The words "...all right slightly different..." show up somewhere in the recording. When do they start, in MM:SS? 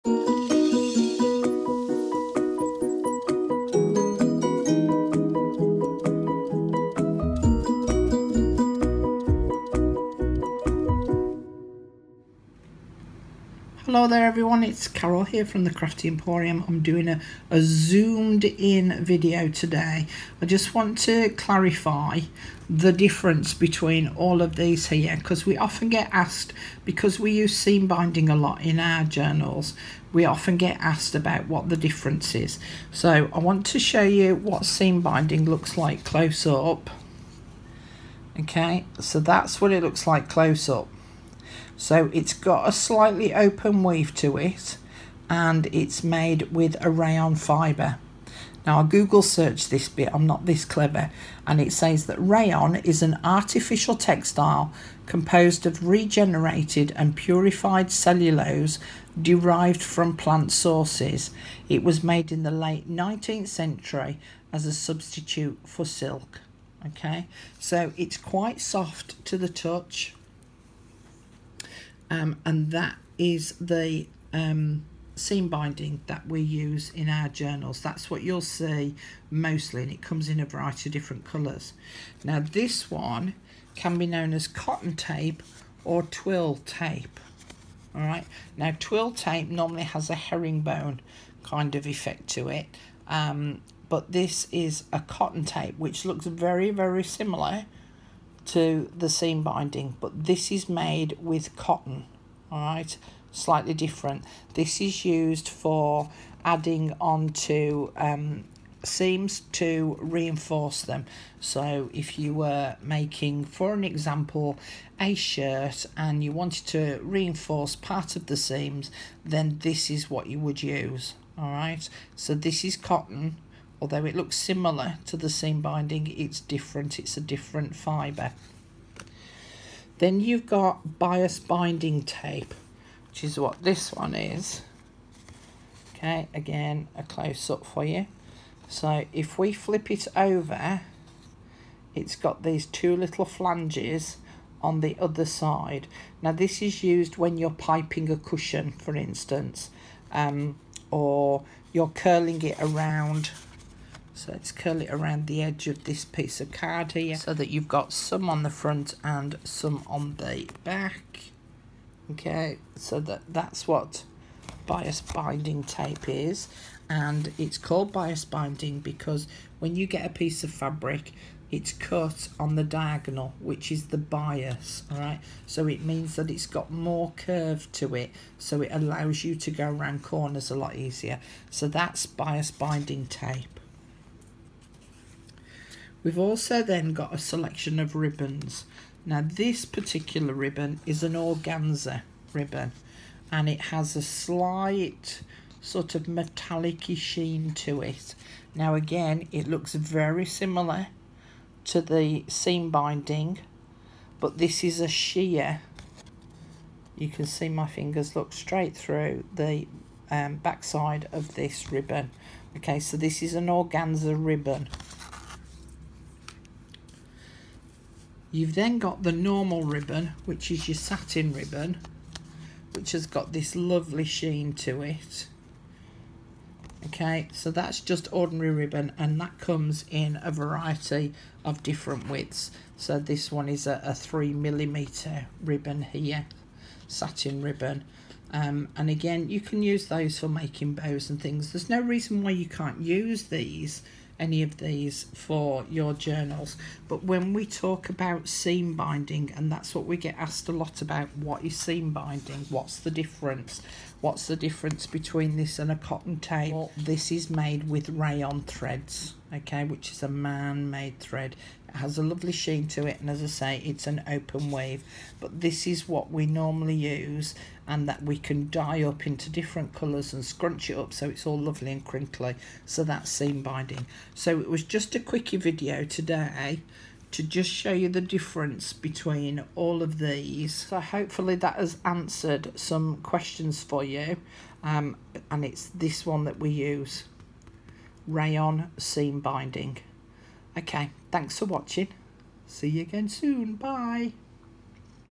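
01:42.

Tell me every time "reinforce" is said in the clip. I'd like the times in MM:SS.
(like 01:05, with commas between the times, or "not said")
01:50, 01:57.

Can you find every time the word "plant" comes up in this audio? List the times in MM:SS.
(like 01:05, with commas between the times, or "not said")
01:00.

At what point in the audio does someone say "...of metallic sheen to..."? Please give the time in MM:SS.
03:15.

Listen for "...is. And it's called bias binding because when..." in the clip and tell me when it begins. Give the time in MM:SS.
02:46.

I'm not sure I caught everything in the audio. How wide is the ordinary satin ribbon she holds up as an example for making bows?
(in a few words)
3 millimeters.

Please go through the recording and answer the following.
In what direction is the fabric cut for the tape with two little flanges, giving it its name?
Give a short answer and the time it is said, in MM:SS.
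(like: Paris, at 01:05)
diagonal, at 02:52.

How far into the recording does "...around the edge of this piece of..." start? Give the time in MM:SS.
02:34.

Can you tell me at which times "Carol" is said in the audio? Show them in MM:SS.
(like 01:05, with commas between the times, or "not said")
00:14.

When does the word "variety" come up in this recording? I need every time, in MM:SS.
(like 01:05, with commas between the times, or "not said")
01:20, 03:50.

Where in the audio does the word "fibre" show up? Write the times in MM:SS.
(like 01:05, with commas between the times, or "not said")
00:47, 02:07.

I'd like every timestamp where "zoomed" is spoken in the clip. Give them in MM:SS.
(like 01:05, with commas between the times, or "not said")
00:17.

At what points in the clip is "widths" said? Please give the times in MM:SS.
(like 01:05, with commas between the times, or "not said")
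03:52.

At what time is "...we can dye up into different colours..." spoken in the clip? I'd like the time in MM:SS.
04:28.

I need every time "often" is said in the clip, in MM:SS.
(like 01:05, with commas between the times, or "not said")
00:25, 00:30.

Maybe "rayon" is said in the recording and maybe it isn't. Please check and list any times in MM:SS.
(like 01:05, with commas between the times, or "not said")
00:46, 00:52, 04:17, 04:48.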